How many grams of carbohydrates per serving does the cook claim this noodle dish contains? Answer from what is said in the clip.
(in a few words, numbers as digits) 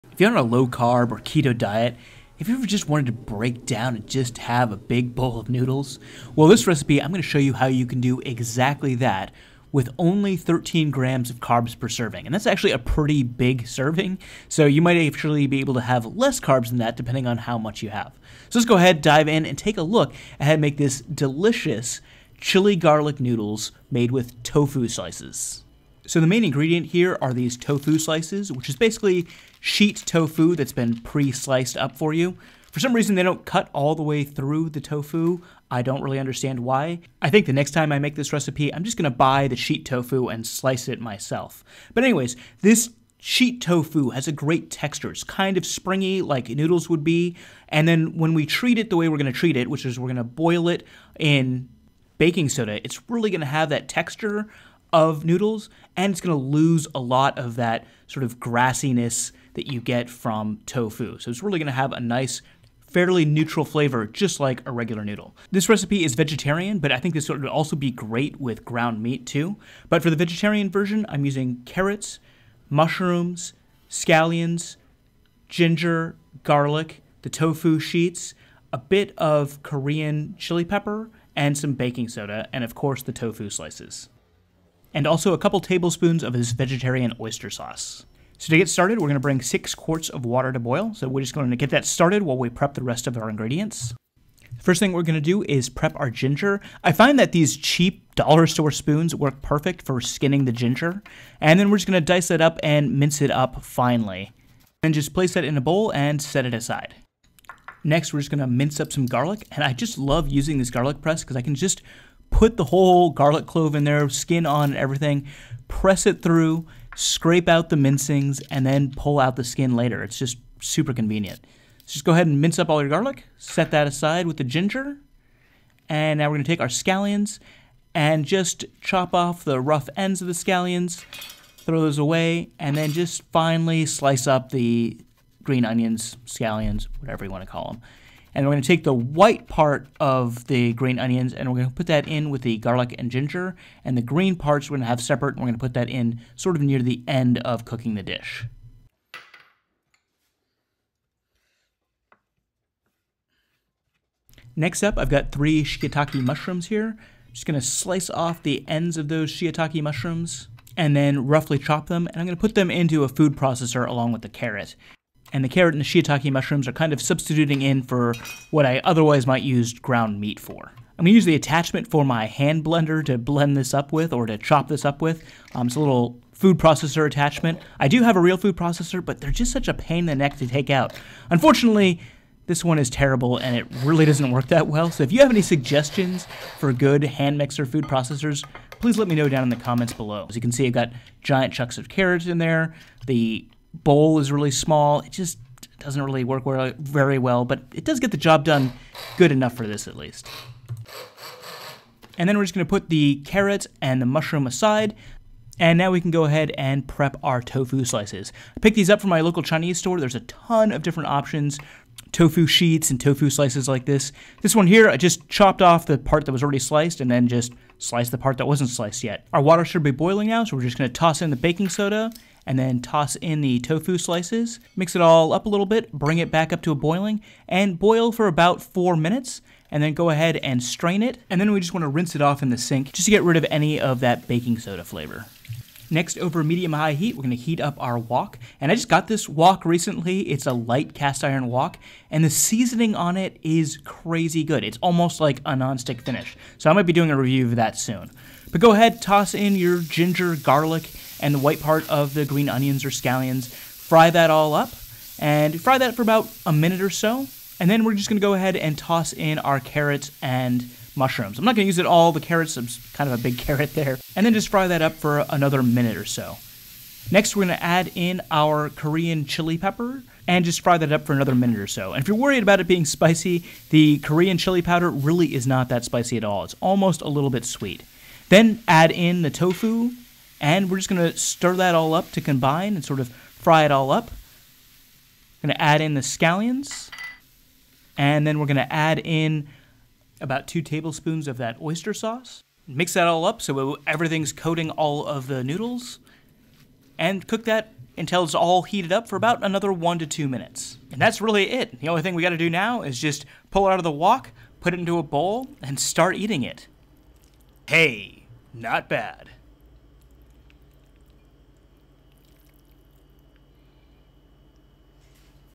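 13 grams.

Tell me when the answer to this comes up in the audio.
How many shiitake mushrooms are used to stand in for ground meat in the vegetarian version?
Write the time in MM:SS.
02:35.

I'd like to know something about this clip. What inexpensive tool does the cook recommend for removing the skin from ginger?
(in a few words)
dollar store spoons.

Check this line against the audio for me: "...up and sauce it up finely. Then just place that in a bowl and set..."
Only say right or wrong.
wrong.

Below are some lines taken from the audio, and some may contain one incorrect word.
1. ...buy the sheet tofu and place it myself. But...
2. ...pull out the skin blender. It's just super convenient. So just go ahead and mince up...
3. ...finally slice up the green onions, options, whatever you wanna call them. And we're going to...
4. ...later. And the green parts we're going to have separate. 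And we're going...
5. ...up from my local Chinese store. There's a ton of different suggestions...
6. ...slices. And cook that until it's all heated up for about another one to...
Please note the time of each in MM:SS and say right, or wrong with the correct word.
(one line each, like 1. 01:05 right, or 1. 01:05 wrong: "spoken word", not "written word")
1. 00:39 wrong: "slice", not "place"
2. 01:58 wrong: "later", not "blender"
3. 02:13 wrong: "scallions", not "options"
4. 02:23 wrong: "ginger", not "later"
5. 03:28 wrong: "options", not "suggestions"
6. 04:55 wrong: "noodles", not "slices".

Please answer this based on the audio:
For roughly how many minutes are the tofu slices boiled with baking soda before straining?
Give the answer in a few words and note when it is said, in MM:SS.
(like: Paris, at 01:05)
4 minutes, at 03:48.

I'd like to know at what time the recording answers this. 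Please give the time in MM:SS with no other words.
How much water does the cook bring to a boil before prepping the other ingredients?
01:29.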